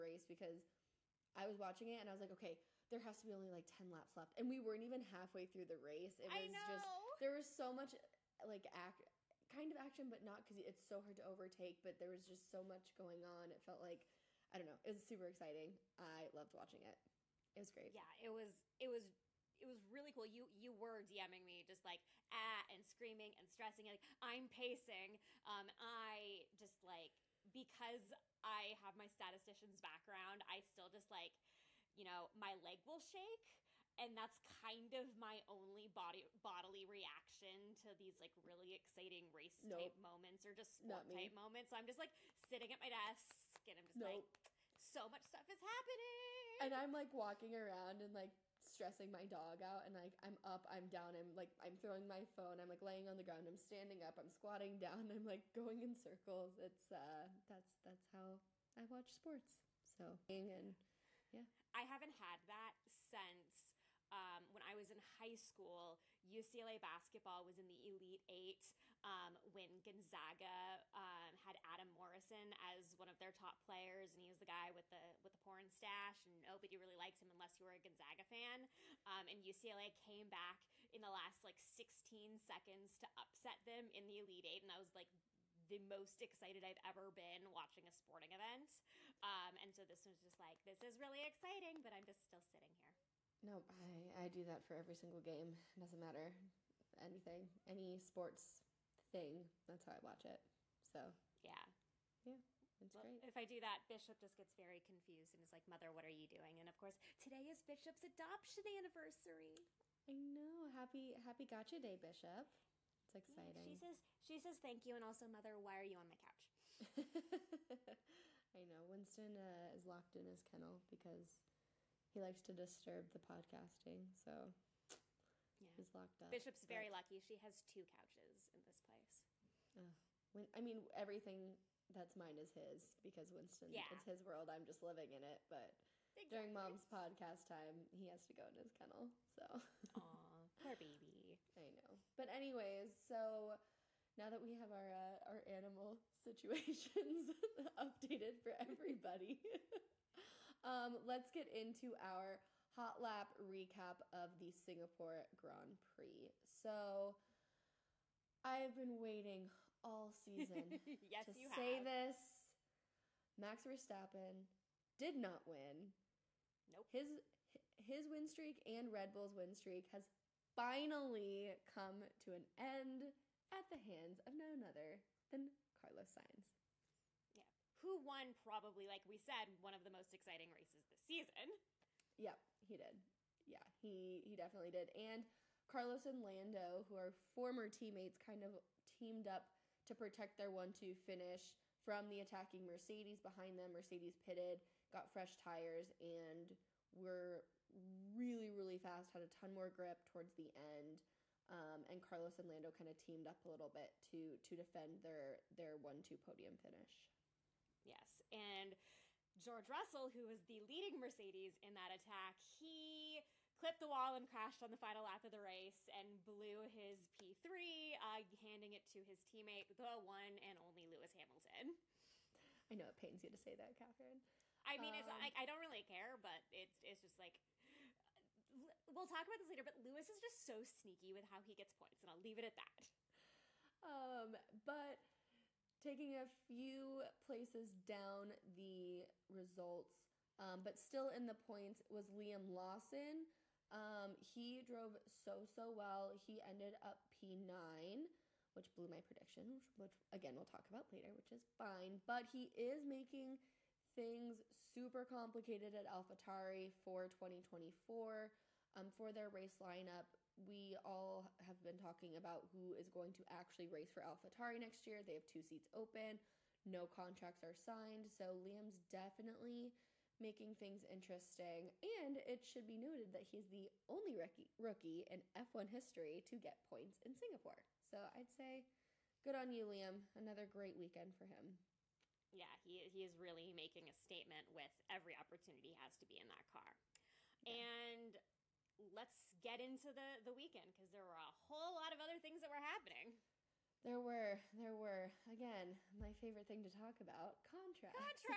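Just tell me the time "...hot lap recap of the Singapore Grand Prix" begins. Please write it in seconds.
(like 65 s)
152 s.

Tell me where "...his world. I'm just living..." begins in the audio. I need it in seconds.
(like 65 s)
134 s.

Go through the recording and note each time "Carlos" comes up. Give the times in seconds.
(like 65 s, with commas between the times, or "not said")
175 s, 185 s, 202 s.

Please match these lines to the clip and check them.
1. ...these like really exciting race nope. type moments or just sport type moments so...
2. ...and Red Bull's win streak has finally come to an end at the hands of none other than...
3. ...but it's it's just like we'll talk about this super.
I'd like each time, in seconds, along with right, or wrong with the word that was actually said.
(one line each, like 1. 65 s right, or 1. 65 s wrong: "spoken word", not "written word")
1. 37 s right
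2. 168 s right
3. 226 s wrong: "later", not "super".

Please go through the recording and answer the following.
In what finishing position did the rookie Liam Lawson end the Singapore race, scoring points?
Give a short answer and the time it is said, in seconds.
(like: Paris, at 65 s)
P9, at 247 s.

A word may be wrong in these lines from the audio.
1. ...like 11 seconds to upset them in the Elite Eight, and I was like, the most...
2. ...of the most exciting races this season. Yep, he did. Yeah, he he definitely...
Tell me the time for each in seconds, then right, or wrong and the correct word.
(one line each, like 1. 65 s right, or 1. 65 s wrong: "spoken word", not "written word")
1. 81 s wrong: "16", not "11"
2. 179 s right.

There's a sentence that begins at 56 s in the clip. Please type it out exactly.
It's uh that's that's how I watch sports.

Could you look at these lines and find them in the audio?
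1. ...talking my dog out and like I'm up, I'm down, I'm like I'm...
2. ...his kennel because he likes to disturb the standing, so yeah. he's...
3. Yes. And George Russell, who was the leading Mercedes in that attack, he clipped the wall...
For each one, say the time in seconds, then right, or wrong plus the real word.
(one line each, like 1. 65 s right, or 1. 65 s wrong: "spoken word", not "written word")
1. 48 s wrong: "stressing", not "talking"
2. 120 s wrong: "podcasting", not "standing"
3. 207 s right.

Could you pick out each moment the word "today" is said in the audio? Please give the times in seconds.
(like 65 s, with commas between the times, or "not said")
107 s.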